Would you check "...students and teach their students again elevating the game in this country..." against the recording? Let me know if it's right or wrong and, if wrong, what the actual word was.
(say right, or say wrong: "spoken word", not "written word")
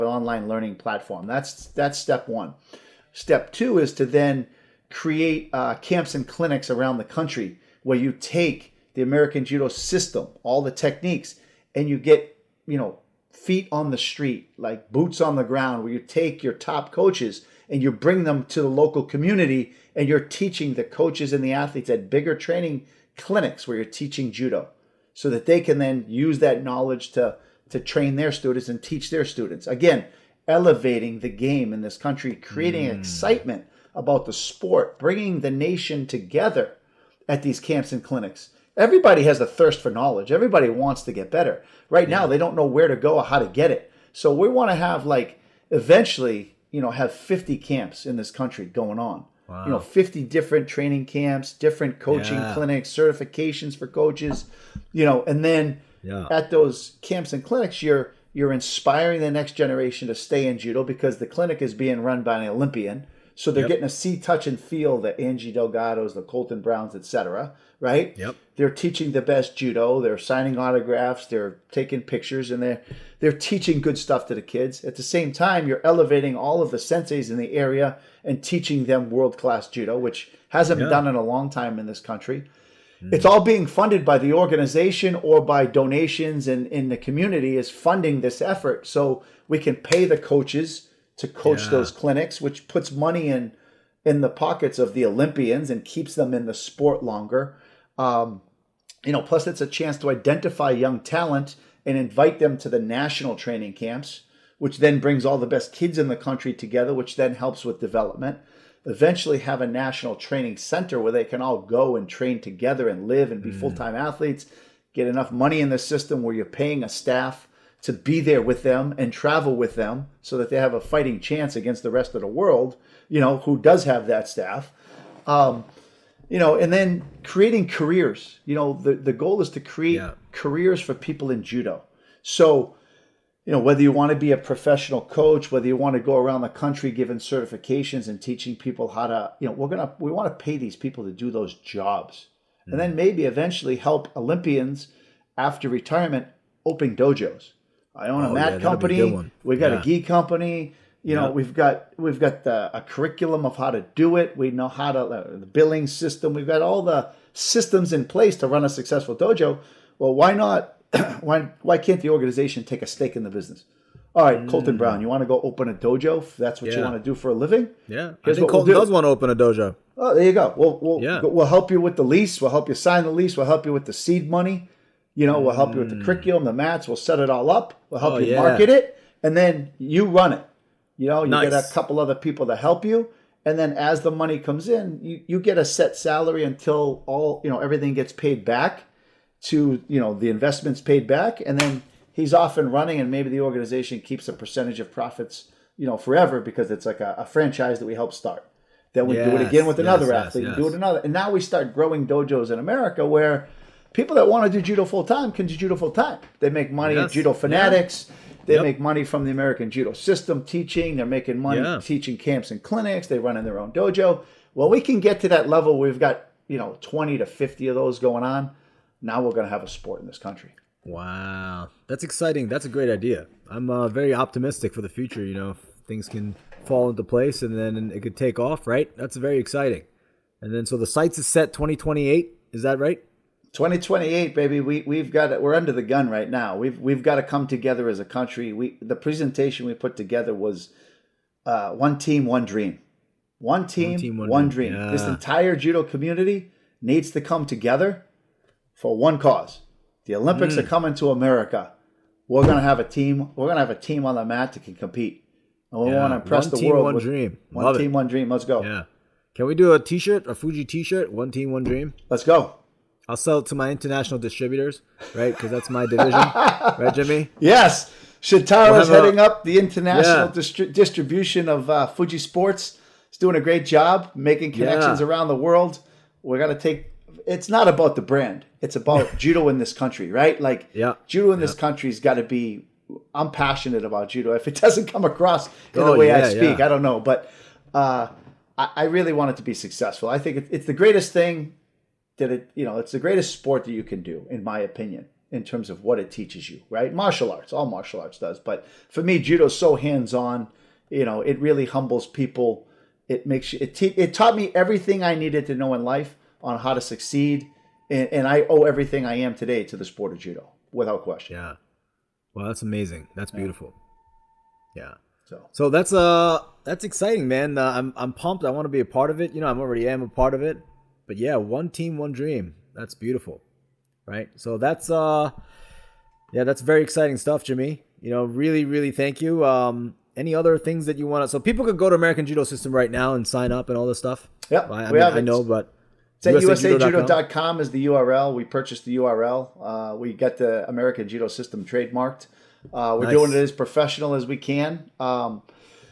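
right.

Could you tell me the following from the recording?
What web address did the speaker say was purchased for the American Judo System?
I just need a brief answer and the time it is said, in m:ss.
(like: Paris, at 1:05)
usajudo.com, at 5:36.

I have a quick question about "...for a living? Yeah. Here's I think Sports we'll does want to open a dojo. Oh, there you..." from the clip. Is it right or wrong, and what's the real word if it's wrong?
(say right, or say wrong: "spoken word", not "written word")
wrong: "Colton", not "Sports".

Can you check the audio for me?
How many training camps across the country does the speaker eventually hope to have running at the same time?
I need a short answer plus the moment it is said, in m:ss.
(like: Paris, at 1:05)
50, at 0:47.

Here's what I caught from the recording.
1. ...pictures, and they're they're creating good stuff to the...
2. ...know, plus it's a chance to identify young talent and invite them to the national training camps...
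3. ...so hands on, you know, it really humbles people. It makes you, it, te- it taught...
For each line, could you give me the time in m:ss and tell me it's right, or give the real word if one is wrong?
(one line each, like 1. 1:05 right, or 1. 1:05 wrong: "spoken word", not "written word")
1. 1:12 wrong: "teaching", not "creating"
2. 1:39 right
3. 4:59 right.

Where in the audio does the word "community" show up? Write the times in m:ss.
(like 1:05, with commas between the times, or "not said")
0:19, 1:26, 4:05.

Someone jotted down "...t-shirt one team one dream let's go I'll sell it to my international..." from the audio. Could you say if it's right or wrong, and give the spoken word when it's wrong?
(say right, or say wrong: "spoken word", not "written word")
right.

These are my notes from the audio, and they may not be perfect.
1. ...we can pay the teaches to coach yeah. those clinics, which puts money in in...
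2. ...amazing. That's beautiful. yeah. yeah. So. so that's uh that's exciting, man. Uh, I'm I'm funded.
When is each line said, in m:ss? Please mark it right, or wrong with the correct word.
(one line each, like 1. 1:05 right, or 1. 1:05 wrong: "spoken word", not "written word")
1. 1:29 wrong: "coaches", not "teaches"
2. 5:12 wrong: "pumped", not "funded".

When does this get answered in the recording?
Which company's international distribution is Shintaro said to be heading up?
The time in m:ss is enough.
4:31.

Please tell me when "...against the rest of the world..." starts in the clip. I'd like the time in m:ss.
2:01.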